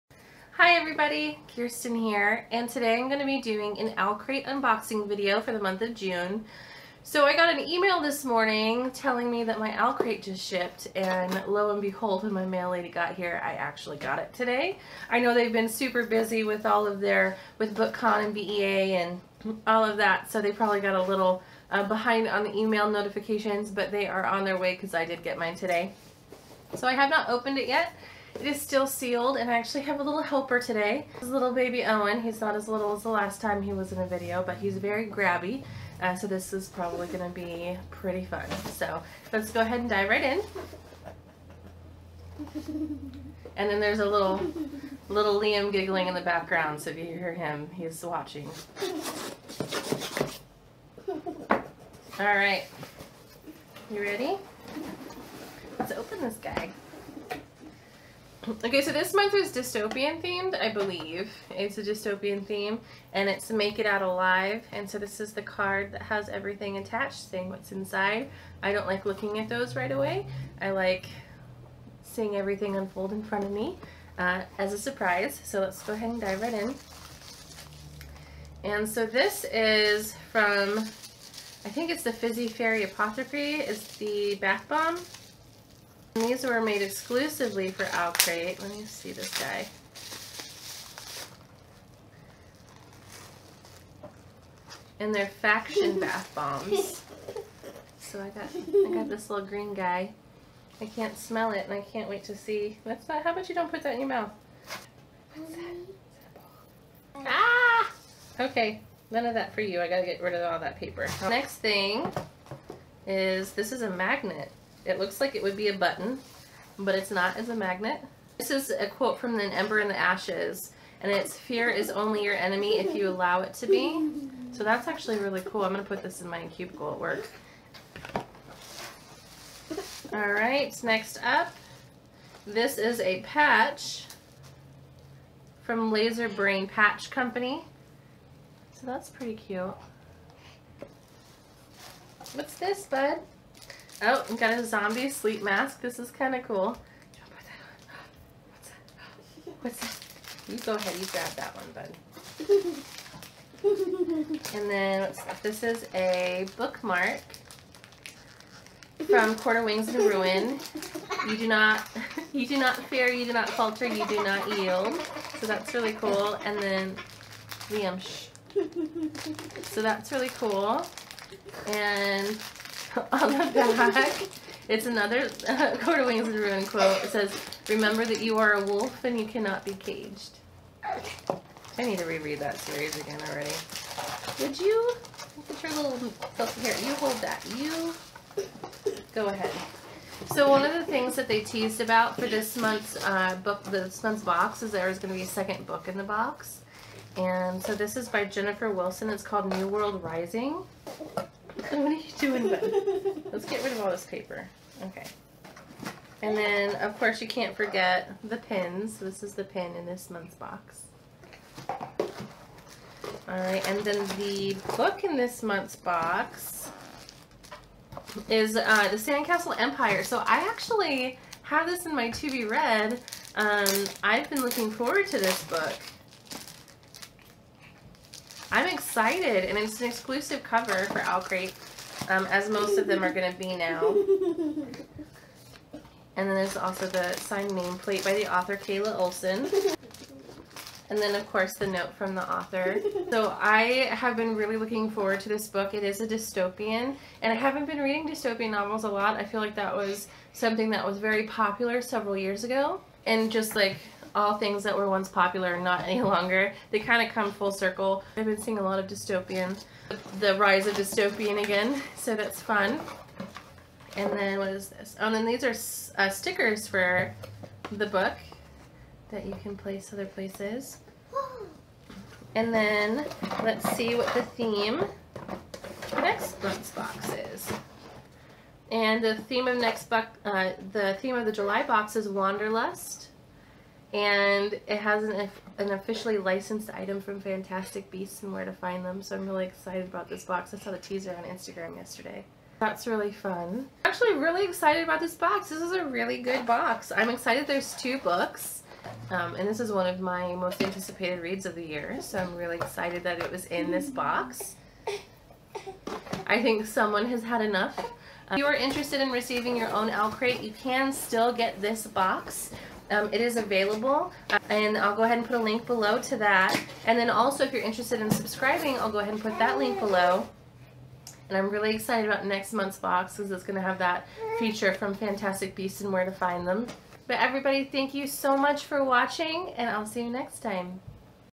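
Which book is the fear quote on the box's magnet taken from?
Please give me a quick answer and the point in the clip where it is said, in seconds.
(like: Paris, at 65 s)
An Ember in the Ashes, at 119 s.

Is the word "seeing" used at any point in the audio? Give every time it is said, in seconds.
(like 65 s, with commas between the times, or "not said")
72 s, 258 s.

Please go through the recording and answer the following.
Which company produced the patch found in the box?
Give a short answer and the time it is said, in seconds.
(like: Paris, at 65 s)
Laser Brain Patch Company, at 135 s.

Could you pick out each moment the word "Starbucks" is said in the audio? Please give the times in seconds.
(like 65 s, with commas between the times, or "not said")
not said.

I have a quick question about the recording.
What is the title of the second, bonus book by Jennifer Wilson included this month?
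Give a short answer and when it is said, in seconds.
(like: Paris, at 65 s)
New World Rising, at 199 s.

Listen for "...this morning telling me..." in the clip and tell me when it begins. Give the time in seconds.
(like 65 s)
7 s.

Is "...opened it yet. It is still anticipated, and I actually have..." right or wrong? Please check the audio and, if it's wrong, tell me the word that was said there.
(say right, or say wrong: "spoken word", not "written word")
wrong: "sealed", not "anticipated".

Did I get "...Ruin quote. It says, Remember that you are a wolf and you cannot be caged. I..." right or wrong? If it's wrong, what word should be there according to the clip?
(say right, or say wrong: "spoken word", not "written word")
right.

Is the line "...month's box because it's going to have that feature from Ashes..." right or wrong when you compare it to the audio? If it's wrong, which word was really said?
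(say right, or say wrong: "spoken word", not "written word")
wrong: "Fantastic", not "Ashes".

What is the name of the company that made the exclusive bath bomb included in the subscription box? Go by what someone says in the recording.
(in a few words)
Fizzy Fairy Apothecary.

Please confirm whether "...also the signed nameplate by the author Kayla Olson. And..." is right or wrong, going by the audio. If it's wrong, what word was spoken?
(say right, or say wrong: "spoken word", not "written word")
right.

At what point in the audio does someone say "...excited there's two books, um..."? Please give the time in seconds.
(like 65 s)
297 s.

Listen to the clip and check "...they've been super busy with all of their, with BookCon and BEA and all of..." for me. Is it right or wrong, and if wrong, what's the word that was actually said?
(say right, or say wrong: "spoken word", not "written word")
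right.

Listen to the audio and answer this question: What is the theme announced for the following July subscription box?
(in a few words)
Wanderlust.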